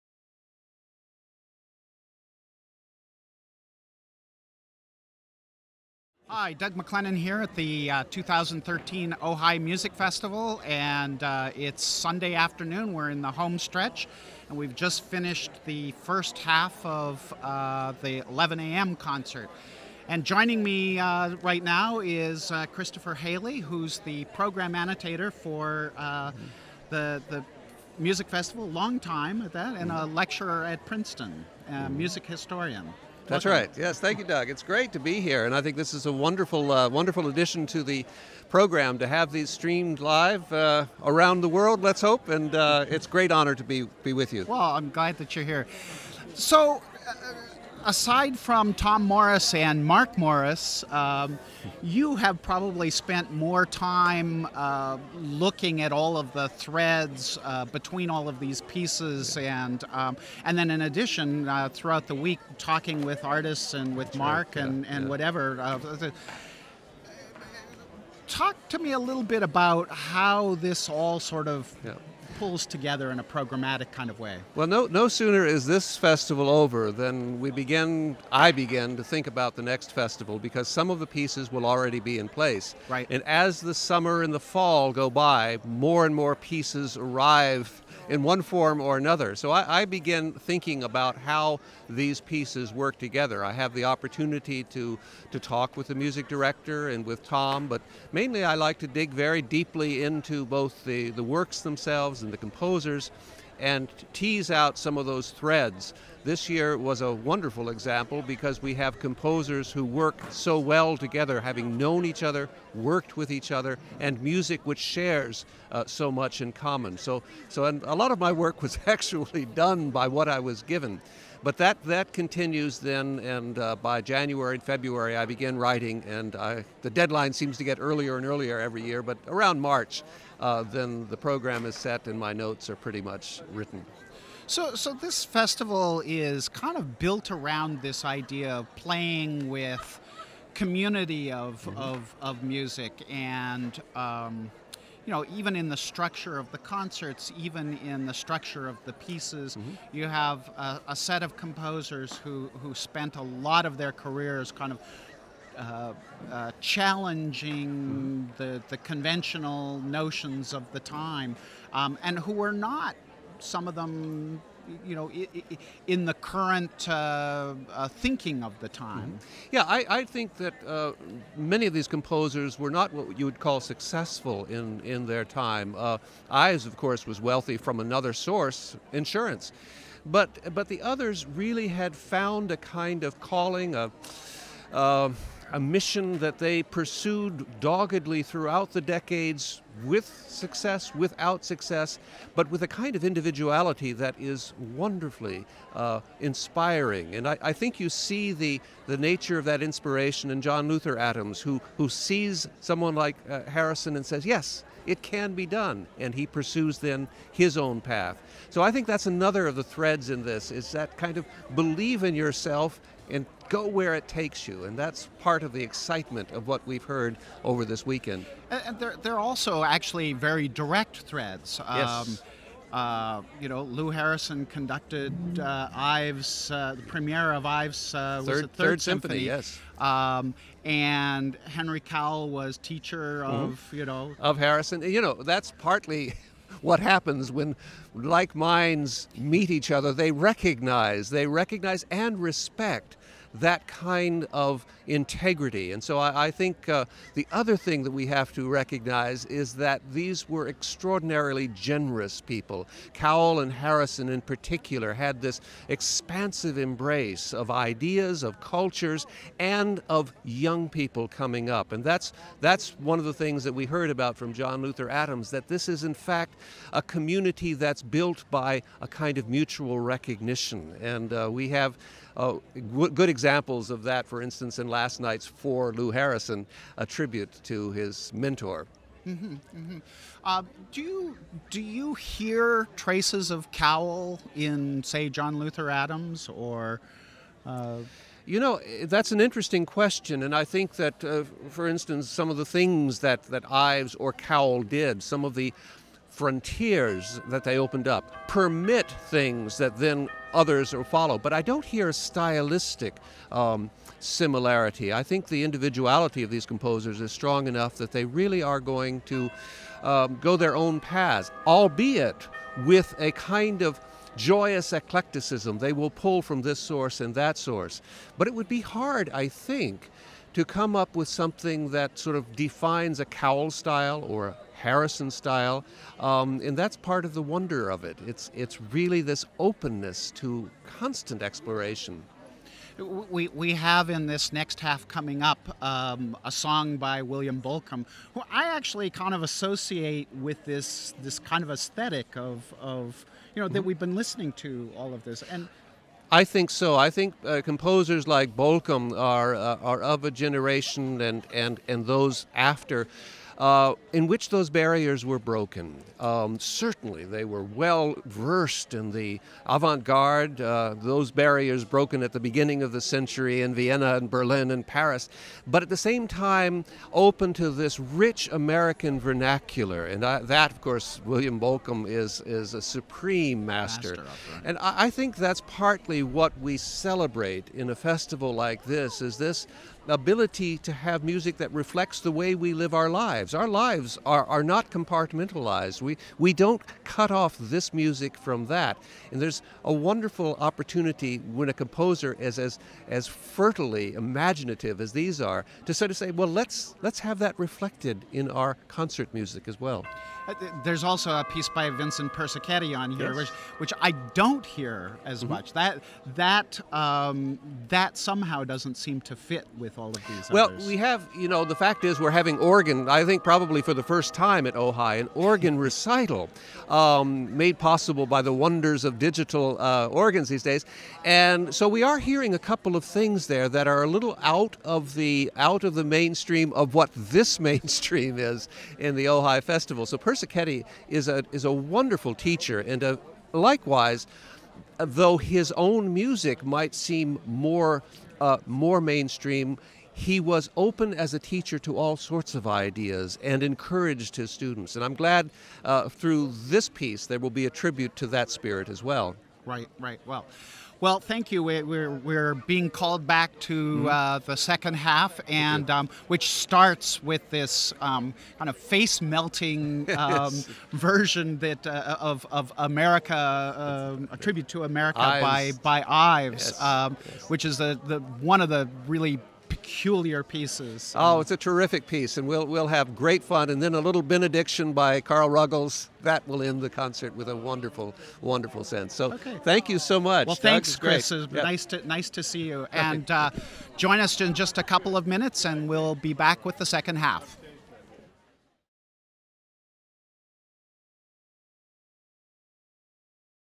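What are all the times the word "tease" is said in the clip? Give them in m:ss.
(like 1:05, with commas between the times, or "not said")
1:44.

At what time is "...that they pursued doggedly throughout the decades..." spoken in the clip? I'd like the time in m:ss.
3:06.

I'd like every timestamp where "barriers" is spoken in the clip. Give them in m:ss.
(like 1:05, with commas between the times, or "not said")
5:54, 6:01.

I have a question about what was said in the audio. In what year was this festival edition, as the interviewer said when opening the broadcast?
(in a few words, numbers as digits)
2013.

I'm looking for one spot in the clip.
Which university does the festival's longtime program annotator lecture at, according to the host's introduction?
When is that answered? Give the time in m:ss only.
0:30.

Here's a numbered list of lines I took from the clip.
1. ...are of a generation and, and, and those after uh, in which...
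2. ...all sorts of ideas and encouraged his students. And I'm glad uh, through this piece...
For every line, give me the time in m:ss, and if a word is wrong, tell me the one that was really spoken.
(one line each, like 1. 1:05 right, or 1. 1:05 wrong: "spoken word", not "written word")
1. 5:49 right
2. 7:21 right.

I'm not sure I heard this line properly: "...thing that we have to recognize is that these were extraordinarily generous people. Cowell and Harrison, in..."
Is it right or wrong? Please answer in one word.
right.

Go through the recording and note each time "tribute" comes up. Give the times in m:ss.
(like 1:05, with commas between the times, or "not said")
4:36, 7:27, 7:44.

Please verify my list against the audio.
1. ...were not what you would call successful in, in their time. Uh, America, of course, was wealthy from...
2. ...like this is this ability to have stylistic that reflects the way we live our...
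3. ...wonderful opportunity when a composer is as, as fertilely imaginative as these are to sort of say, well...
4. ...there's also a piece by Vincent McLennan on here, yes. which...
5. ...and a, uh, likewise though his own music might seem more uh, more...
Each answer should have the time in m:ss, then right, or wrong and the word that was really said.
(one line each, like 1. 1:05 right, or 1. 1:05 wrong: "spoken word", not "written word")
1. 2:52 wrong: "Ives", not "America"
2. 6:18 wrong: "music", not "stylistic"
3. 6:29 right
4. 6:40 wrong: "Persichetti", not "McLennan"
5. 7:12 right.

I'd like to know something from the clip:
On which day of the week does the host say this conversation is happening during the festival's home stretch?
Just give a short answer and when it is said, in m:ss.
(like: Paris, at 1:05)
Sunday, at 0:11.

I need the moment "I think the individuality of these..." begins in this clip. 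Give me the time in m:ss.
5:04.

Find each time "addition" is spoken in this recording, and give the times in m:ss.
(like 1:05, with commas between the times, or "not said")
0:37, 1:00.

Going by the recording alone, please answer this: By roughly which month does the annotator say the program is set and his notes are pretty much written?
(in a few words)
March.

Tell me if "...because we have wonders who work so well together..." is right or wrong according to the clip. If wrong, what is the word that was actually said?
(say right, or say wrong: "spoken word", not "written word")
wrong: "composers", not "wonders".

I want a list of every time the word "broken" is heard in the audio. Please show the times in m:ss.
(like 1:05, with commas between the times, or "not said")
5:55, 6:01.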